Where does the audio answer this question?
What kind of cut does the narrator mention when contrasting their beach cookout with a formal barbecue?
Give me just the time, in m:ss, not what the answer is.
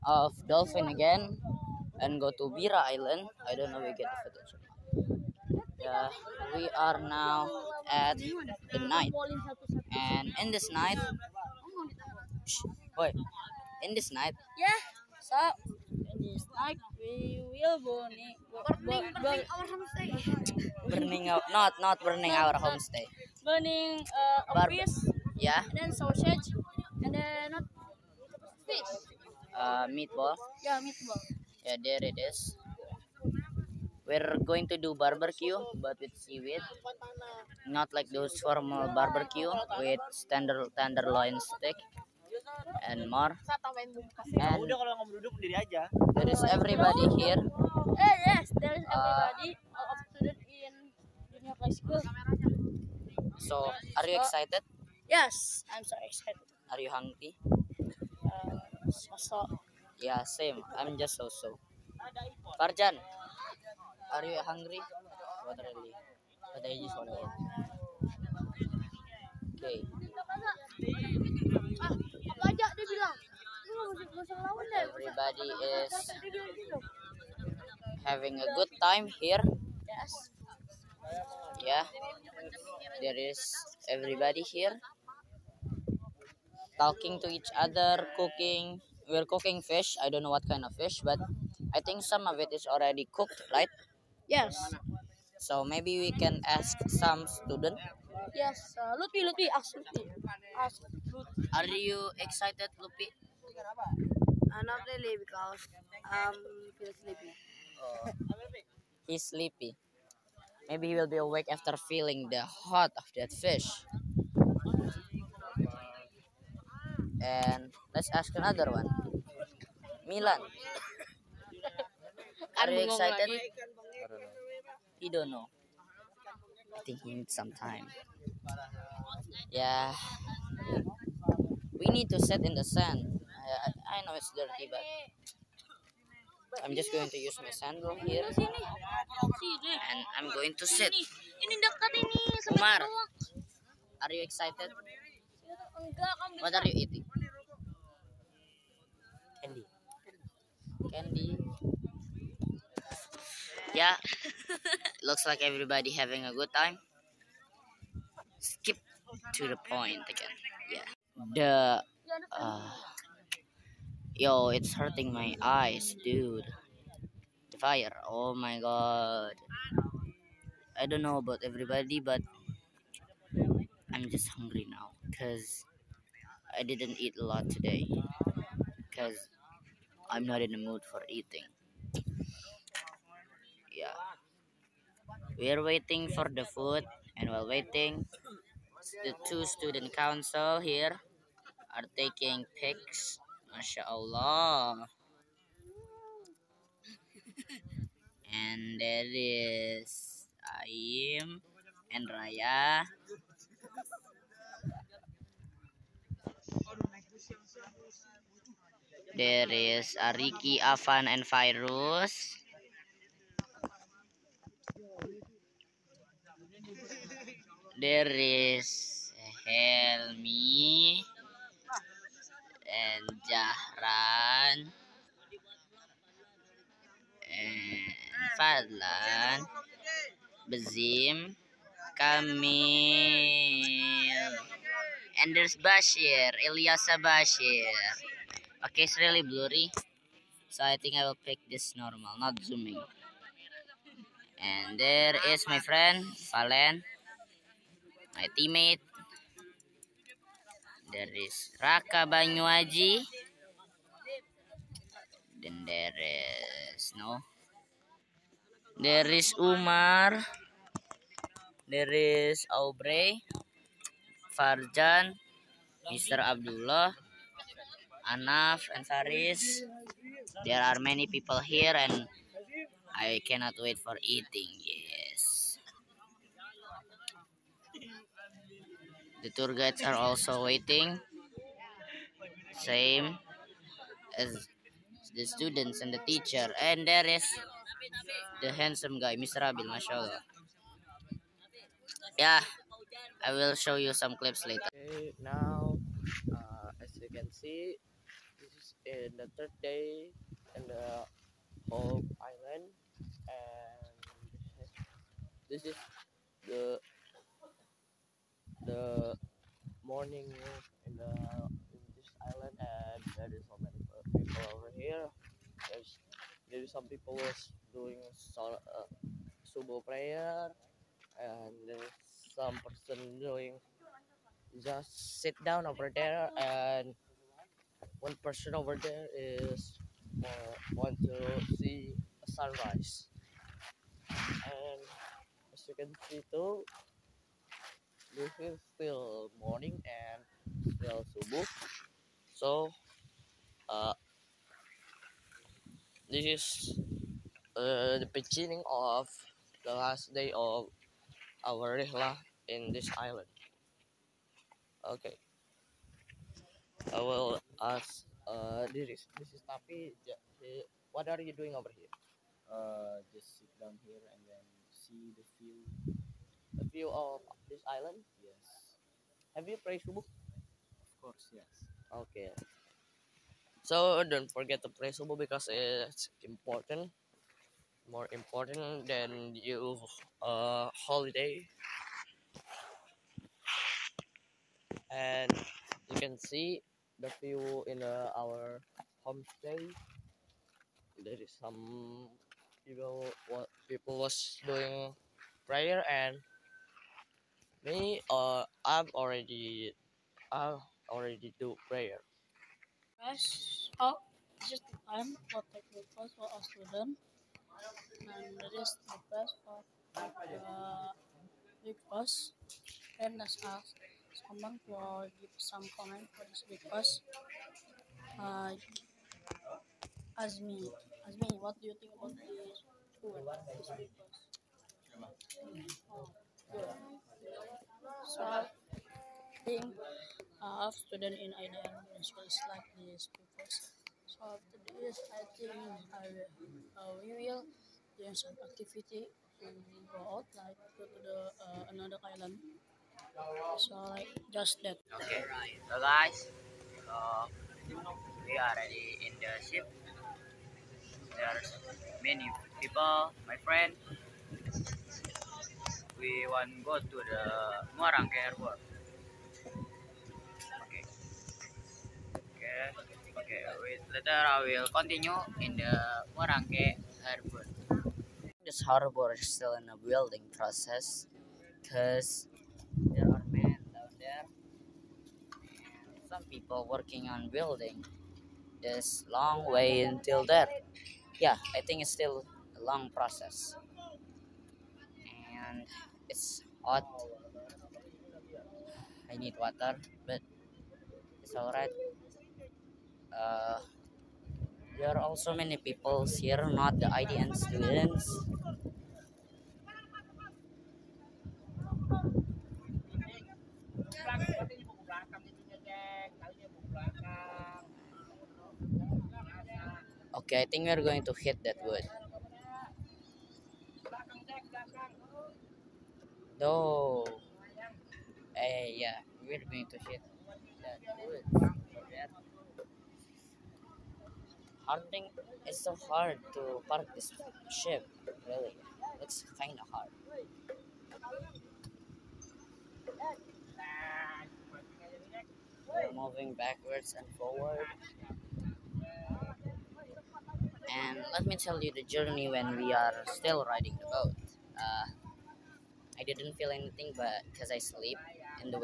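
0:40.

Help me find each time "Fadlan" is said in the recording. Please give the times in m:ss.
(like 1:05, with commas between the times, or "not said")
3:48.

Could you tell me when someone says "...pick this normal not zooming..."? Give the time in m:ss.
4:01.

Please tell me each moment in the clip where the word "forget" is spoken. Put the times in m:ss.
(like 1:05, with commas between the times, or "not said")
6:14.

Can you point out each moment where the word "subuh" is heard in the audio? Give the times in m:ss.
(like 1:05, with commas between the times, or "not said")
5:19, 5:41, 6:09, 6:14.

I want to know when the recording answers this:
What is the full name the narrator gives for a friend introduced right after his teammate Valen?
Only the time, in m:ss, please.
4:11.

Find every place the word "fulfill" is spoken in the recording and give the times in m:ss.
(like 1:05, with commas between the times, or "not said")
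not said.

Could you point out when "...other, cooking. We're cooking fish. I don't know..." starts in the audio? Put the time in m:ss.
1:27.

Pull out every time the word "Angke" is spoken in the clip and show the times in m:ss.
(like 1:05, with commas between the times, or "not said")
7:38, 7:46.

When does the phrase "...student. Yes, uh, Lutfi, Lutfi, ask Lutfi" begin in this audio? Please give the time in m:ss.
1:37.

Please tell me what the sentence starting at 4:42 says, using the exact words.
Same as the students and the teacher.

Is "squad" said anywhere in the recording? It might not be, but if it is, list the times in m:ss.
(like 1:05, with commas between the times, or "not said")
not said.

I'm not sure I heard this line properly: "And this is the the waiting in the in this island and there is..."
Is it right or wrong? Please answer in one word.
wrong.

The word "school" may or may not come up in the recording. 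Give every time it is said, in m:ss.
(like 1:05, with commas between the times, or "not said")
0:51, 7:02.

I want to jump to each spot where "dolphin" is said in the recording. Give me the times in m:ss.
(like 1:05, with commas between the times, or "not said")
0:00.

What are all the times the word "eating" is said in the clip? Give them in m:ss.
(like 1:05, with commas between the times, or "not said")
2:26, 3:01, 4:34.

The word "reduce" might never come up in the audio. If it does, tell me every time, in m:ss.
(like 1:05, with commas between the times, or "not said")
not said.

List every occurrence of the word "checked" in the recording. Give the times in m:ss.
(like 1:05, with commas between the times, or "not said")
not said.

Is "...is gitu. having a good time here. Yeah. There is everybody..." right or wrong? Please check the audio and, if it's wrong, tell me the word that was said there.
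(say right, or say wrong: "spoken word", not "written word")
right.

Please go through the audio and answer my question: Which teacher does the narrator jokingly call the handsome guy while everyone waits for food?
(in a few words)
Mr. Abil.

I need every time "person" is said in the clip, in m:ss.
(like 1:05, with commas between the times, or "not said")
5:22, 5:28.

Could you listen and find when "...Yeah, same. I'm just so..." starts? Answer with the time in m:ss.
0:59.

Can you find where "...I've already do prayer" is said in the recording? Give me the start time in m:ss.
6:40.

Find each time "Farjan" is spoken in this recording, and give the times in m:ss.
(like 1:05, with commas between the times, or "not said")
1:02, 4:24.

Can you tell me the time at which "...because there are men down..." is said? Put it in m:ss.
7:51.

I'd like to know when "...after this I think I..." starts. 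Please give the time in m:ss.
7:14.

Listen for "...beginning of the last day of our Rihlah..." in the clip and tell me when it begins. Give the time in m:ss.
5:48.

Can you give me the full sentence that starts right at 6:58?
Uh, as me, as me, what do you think about this?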